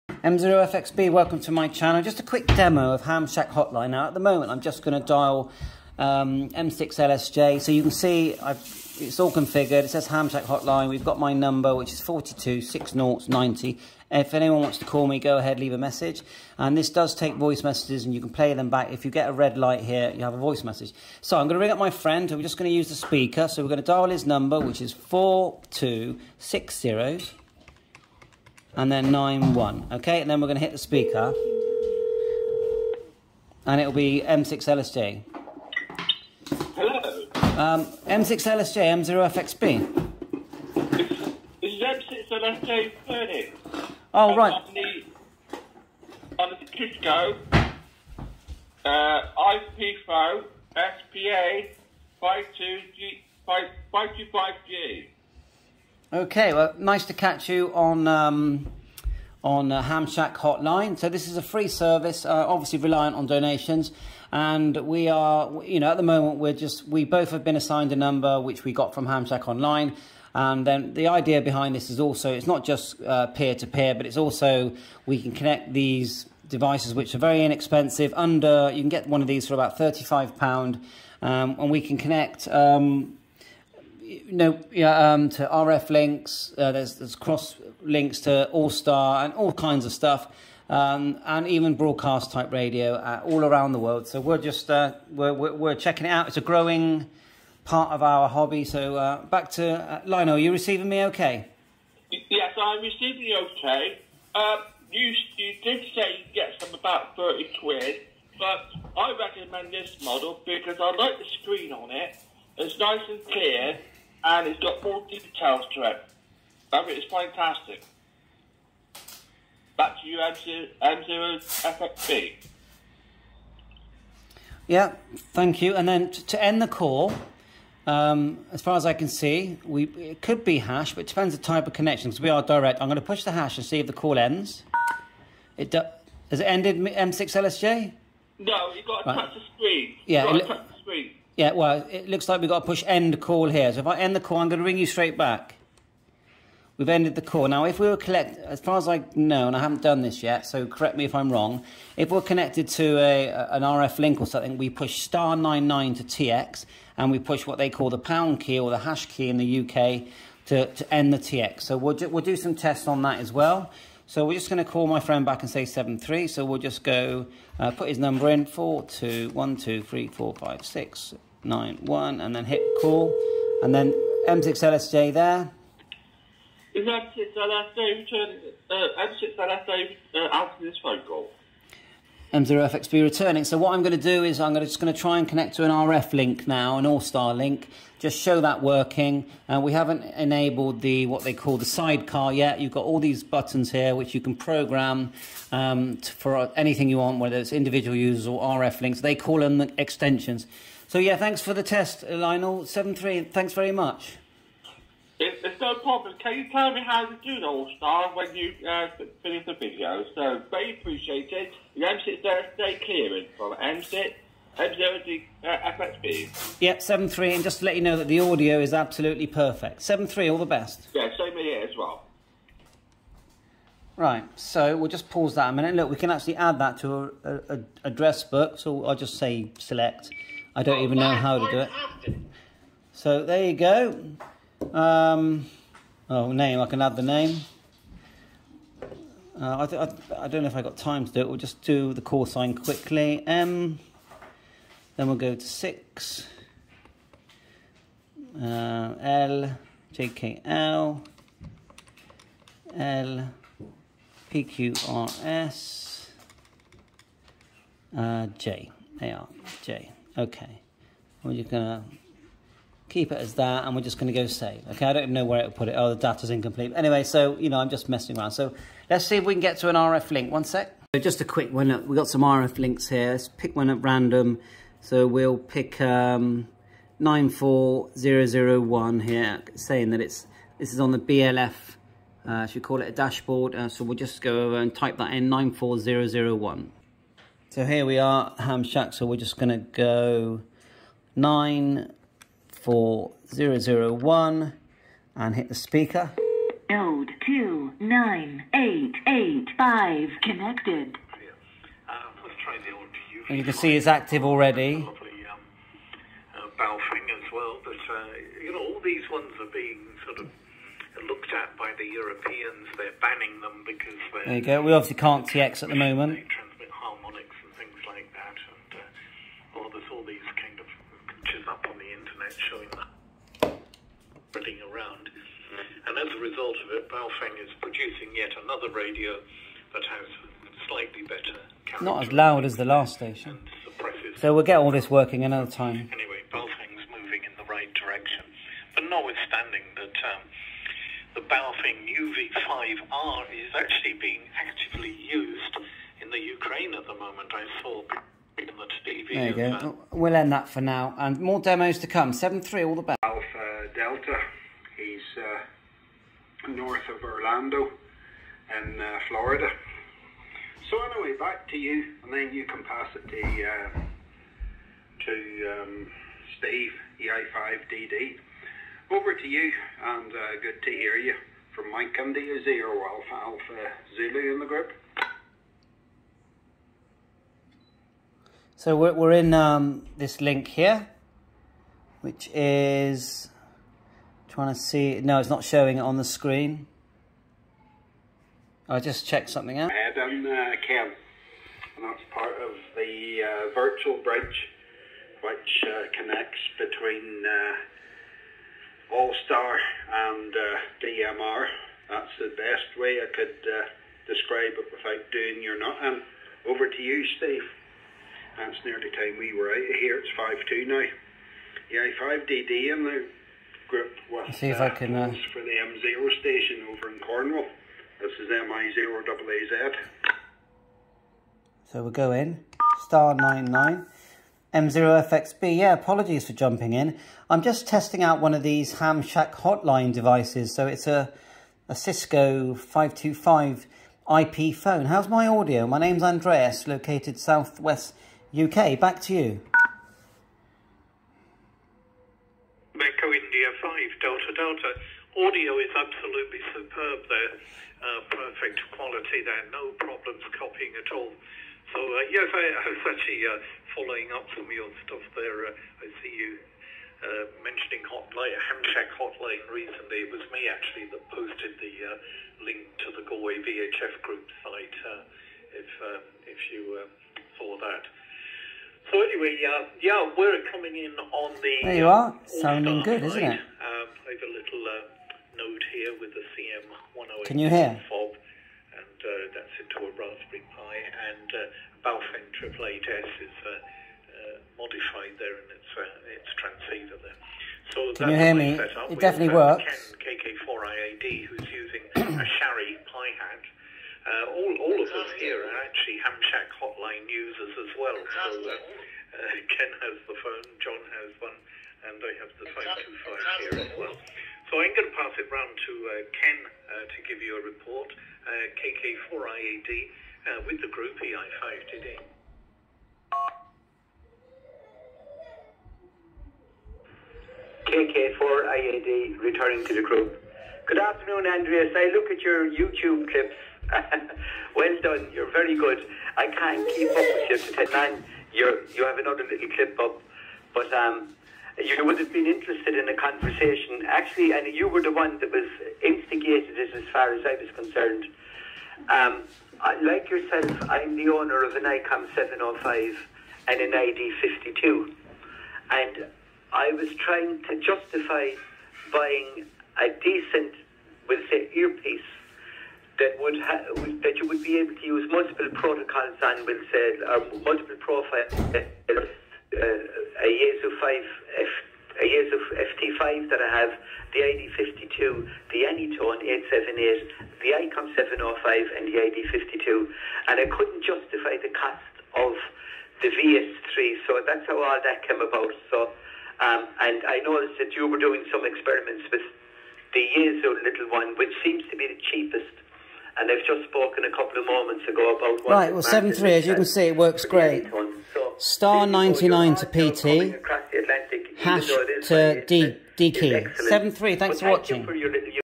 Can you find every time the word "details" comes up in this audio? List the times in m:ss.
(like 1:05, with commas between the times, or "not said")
1:55.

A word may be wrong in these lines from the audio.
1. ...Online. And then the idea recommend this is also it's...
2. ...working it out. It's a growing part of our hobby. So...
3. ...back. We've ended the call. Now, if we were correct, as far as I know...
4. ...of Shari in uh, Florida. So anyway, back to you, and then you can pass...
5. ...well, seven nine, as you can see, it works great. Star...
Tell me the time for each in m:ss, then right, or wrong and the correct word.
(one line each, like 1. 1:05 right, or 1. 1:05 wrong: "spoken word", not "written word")
1. 1:09 wrong: "behind", not "recommend"
2. 1:35 wrong: "checking", not "working"
3. 2:25 wrong: "collect", not "correct"
4. 5:56 wrong: "Orlando", not "Shari"
5. 9:45 wrong: "three", not "nine".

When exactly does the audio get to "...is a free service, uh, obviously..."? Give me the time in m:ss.
1:01.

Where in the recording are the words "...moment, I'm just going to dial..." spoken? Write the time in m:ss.
0:04.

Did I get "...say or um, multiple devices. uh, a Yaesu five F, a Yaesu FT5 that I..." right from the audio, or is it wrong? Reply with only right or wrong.
wrong.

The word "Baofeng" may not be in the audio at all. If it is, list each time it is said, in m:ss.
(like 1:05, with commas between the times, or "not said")
5:06, 5:26, 5:36, 5:41, 8:01.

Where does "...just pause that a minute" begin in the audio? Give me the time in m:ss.
3:44.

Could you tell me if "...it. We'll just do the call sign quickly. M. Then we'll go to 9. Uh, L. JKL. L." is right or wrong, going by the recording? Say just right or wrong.
wrong.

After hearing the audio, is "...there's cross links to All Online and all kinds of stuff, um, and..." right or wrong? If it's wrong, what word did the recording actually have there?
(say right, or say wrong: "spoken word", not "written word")
wrong: "Star", not "Online".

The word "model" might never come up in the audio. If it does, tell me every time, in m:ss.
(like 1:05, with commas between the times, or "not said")
1:50.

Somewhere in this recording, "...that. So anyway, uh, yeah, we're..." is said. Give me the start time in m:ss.
7:47.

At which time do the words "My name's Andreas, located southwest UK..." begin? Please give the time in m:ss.
7:15.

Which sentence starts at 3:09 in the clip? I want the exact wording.
Uh, we haven't enabled the what they call the sidecar yet.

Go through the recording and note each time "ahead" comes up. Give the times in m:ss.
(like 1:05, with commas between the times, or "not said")
0:15.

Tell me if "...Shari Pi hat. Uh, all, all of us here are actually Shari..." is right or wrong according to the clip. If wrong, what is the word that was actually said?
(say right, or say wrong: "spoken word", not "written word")
wrong: "Hamshack", not "Shari".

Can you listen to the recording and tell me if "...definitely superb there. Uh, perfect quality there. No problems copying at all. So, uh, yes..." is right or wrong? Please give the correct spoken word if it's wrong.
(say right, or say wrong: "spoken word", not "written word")
wrong: "absolutely", not "definitely".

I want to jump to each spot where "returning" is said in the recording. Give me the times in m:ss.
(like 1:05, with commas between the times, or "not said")
3:03, 8:39.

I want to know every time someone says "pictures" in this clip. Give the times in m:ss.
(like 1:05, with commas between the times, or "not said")
5:21.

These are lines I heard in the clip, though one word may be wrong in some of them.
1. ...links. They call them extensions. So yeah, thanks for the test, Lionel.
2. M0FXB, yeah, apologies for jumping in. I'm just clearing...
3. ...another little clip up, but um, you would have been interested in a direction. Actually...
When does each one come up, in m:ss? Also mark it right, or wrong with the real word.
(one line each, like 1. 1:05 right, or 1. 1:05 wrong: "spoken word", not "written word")
1. 3:18 right
2. 7:04 wrong: "testing", not "clearing"
3. 8:48 wrong: "conversation", not "direction".